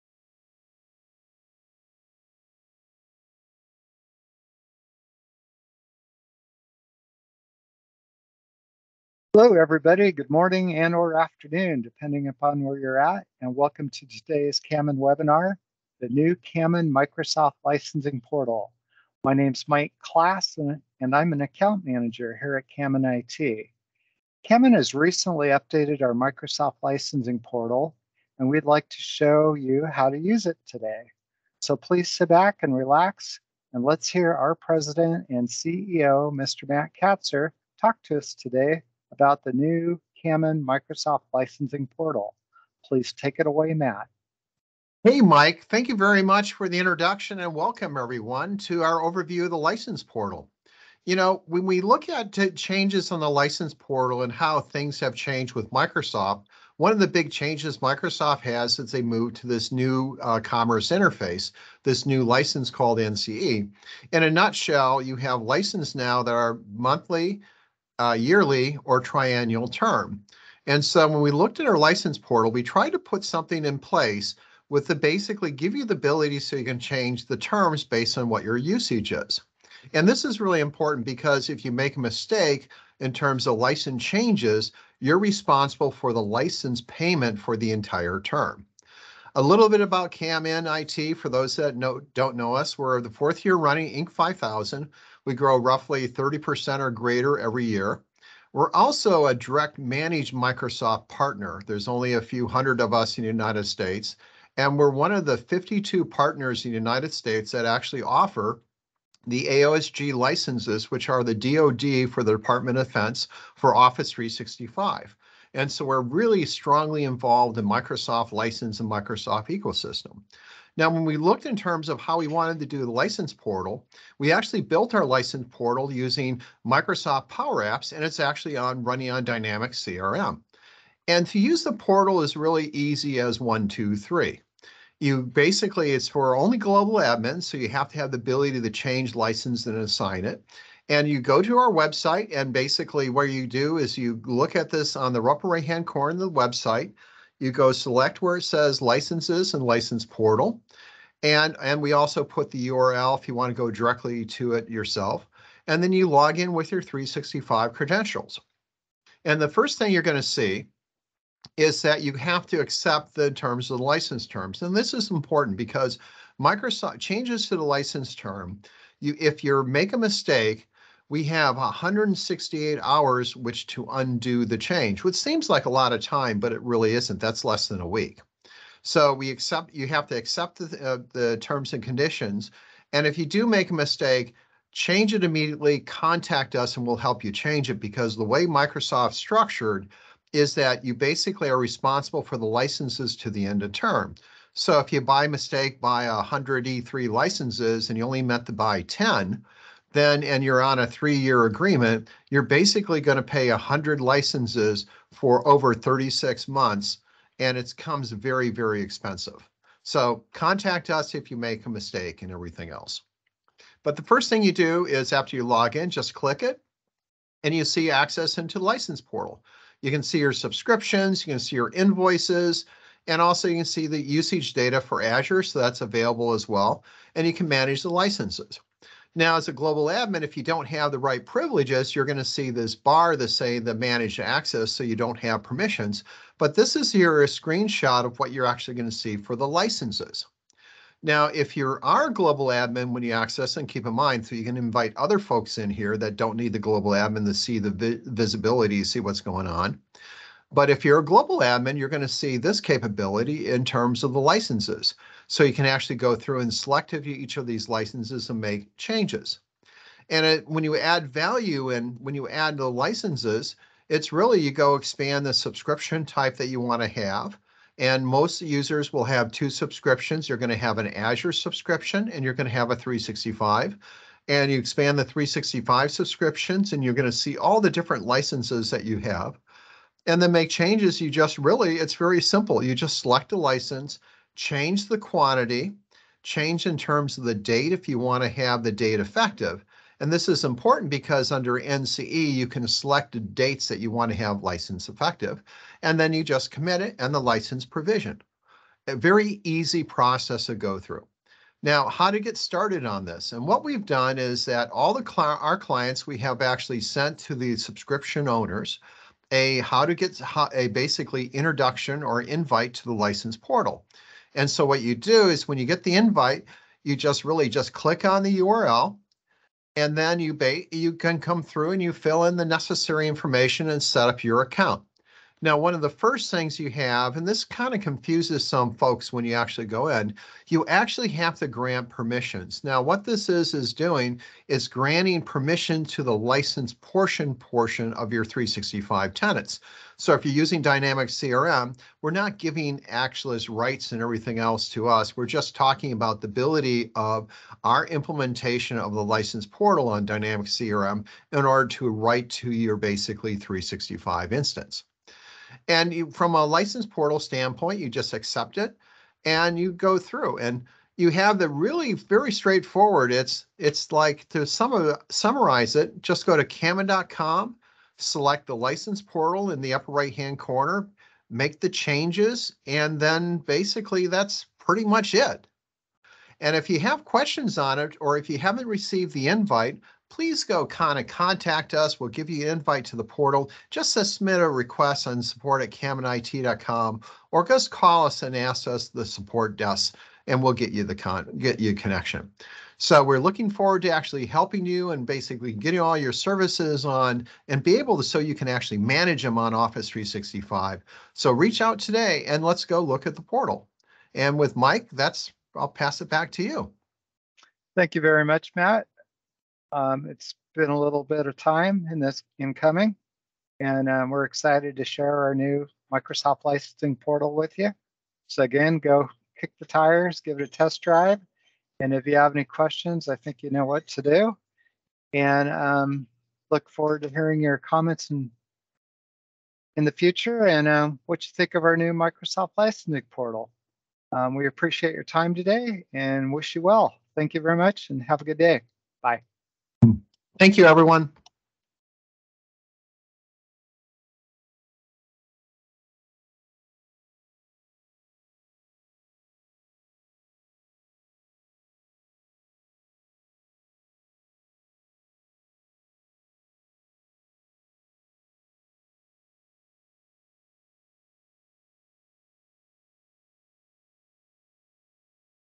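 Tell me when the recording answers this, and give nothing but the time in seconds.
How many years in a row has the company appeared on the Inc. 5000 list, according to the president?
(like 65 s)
93 s.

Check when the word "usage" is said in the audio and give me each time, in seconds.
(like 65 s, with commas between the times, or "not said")
78 s, 223 s.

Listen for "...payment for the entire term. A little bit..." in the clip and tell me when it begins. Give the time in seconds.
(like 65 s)
86 s.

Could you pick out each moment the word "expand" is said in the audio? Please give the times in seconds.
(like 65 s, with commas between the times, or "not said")
264 s, 274 s.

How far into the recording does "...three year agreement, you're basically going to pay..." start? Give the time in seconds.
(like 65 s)
200 s.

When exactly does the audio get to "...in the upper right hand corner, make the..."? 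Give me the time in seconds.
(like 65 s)
369 s.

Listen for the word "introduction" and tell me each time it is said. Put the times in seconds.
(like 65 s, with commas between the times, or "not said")
46 s, 311 s.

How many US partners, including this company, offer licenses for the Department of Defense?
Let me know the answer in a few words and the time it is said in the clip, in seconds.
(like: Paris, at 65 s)
52, at 105 s.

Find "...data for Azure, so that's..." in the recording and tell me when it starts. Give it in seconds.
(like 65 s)
224 s.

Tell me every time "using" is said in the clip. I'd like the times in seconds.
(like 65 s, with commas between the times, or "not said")
125 s, 340 s.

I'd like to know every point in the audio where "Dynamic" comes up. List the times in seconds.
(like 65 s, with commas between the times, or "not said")
129 s, 340 s, 350 s.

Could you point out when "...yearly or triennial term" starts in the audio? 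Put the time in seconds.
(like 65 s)
68 s.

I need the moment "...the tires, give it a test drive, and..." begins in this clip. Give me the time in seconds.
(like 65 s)
419 s.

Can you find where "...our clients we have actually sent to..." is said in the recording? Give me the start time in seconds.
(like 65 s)
305 s.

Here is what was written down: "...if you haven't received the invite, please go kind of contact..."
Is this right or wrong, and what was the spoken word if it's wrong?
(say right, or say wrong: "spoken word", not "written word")
right.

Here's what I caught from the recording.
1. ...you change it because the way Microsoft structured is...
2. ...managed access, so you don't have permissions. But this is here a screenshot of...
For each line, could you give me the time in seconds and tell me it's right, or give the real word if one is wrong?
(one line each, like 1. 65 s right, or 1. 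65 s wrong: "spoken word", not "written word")
1. 187 s right
2. 233 s right.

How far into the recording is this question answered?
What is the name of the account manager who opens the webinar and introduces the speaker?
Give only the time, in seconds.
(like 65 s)
19 s.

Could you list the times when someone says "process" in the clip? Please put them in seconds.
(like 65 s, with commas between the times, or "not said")
299 s.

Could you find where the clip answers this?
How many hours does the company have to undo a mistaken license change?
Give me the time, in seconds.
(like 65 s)
171 s.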